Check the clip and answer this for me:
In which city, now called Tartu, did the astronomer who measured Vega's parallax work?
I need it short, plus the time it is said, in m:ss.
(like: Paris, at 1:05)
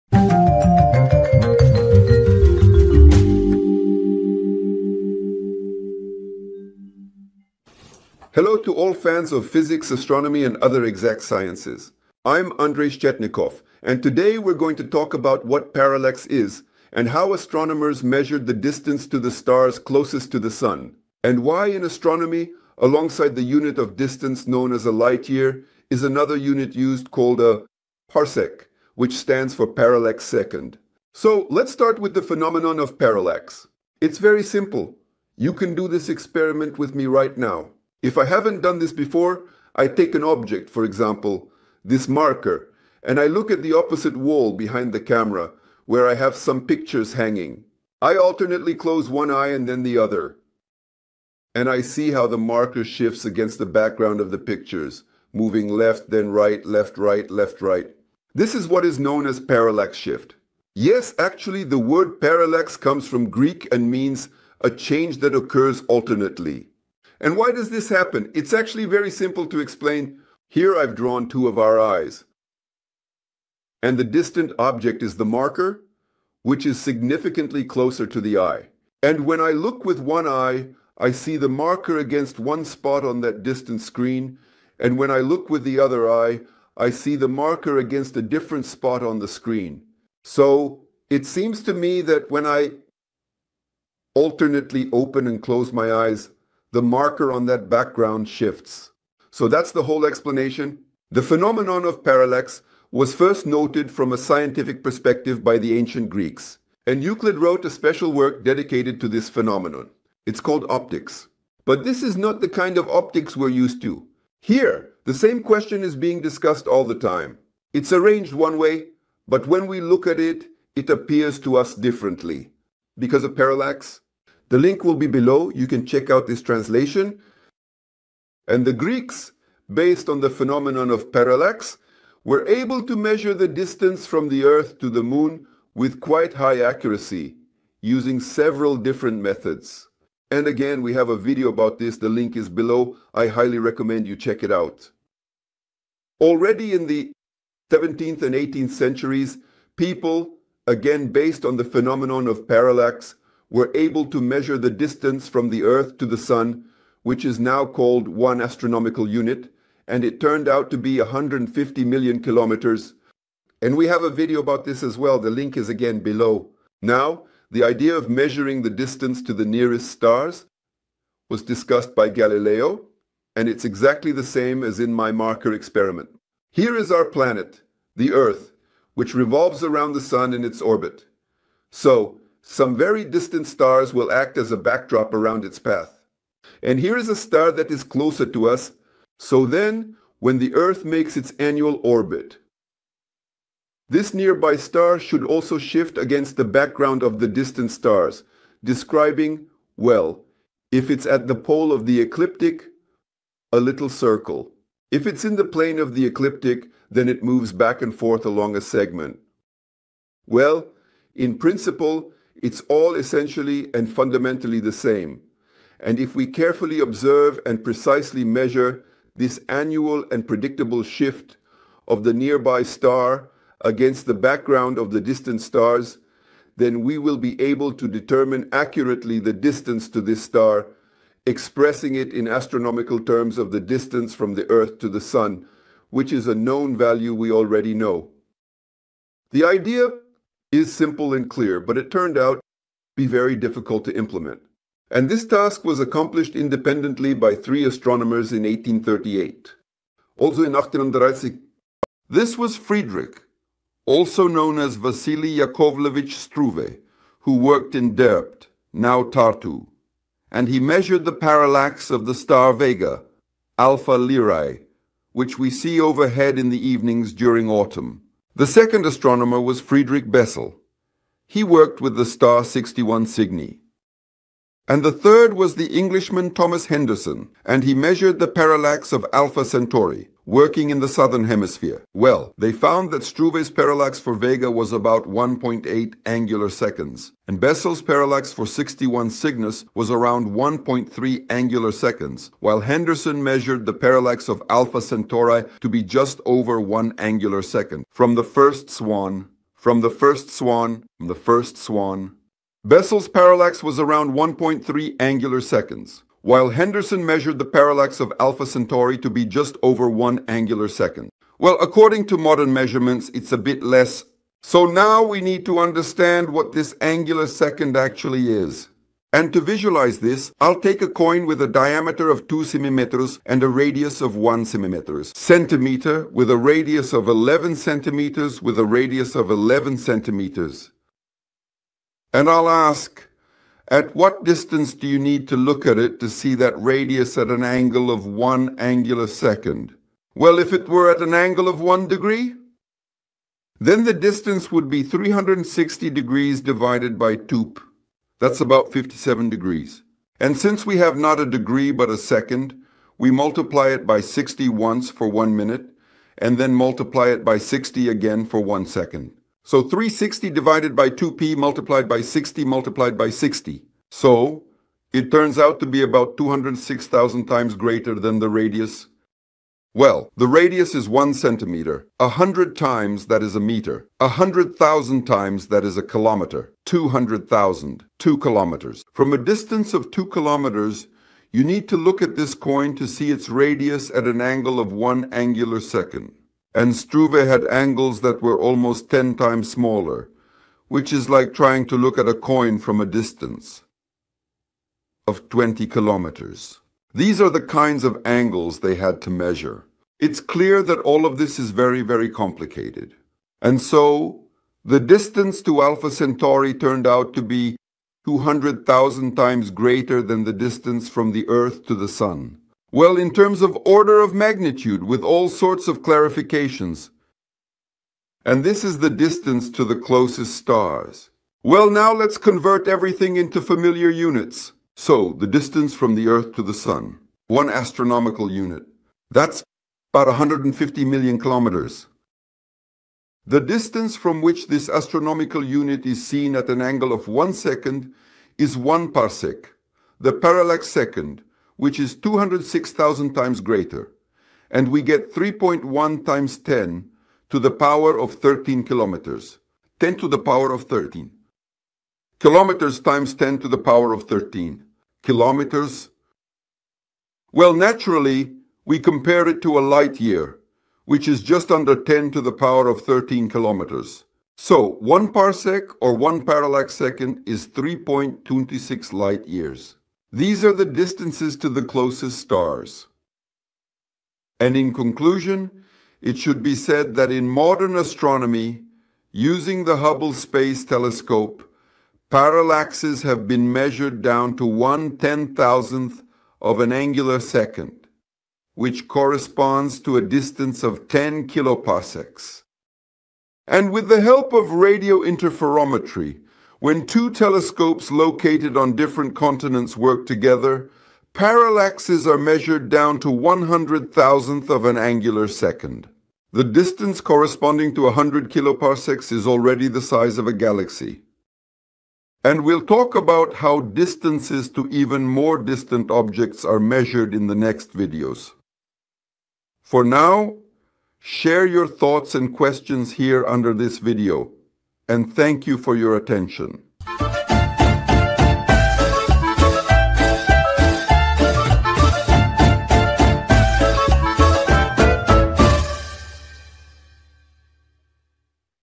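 Derpt, at 4:17.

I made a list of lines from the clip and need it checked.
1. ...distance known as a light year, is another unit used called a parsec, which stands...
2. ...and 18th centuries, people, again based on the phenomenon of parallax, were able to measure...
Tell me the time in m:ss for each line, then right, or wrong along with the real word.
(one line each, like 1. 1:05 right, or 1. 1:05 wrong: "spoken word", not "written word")
1. 0:23 right
2. 2:28 right.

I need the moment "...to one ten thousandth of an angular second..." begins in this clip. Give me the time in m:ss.
8:04.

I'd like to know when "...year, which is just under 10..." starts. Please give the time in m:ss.
7:40.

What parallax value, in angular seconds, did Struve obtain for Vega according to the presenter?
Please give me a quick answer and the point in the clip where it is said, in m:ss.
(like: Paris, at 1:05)
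1.8, at 4:45.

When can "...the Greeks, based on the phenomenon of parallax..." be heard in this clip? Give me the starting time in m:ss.
2:08.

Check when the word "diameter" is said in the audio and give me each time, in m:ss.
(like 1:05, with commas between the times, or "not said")
5:21.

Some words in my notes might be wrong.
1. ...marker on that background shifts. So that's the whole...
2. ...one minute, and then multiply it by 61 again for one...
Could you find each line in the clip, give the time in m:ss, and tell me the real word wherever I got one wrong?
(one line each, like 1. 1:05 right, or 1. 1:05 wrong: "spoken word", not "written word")
1. 1:36 right
2. 5:55 wrong: "60", not "61".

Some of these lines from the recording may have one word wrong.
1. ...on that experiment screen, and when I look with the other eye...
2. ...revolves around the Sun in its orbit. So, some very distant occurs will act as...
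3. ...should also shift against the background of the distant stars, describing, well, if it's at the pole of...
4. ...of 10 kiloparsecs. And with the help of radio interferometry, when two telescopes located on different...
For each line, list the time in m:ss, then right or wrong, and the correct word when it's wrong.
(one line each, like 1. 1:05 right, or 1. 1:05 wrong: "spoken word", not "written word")
1. 1:23 wrong: "distant", not "experiment"
2. 2:59 wrong: "stars", not "occurs"
3. 3:14 right
4. 8:10 right.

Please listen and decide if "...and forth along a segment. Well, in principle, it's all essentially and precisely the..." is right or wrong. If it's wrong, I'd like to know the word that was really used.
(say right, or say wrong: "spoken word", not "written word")
wrong: "fundamentally", not "precisely".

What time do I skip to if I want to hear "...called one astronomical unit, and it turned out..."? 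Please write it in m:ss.
2:37.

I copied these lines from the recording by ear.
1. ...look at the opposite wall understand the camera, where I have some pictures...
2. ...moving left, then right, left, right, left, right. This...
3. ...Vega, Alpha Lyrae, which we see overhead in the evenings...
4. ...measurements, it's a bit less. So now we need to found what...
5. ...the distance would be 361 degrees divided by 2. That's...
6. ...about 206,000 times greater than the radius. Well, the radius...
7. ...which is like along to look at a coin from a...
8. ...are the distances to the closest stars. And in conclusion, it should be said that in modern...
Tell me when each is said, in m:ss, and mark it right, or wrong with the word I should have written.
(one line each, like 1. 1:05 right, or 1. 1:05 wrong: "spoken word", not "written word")
1. 0:43 wrong: "behind", not "understand"
2. 0:55 right
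3. 4:22 right
4. 5:12 wrong: "understand", not "found"
5. 5:43 wrong: "360", not "361"
6. 6:05 right
7. 6:30 wrong: "trying", not "along"
8. 7:50 right.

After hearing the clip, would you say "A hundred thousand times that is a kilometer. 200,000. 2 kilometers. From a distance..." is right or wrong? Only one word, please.
right.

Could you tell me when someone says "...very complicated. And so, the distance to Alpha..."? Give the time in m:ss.
6:41.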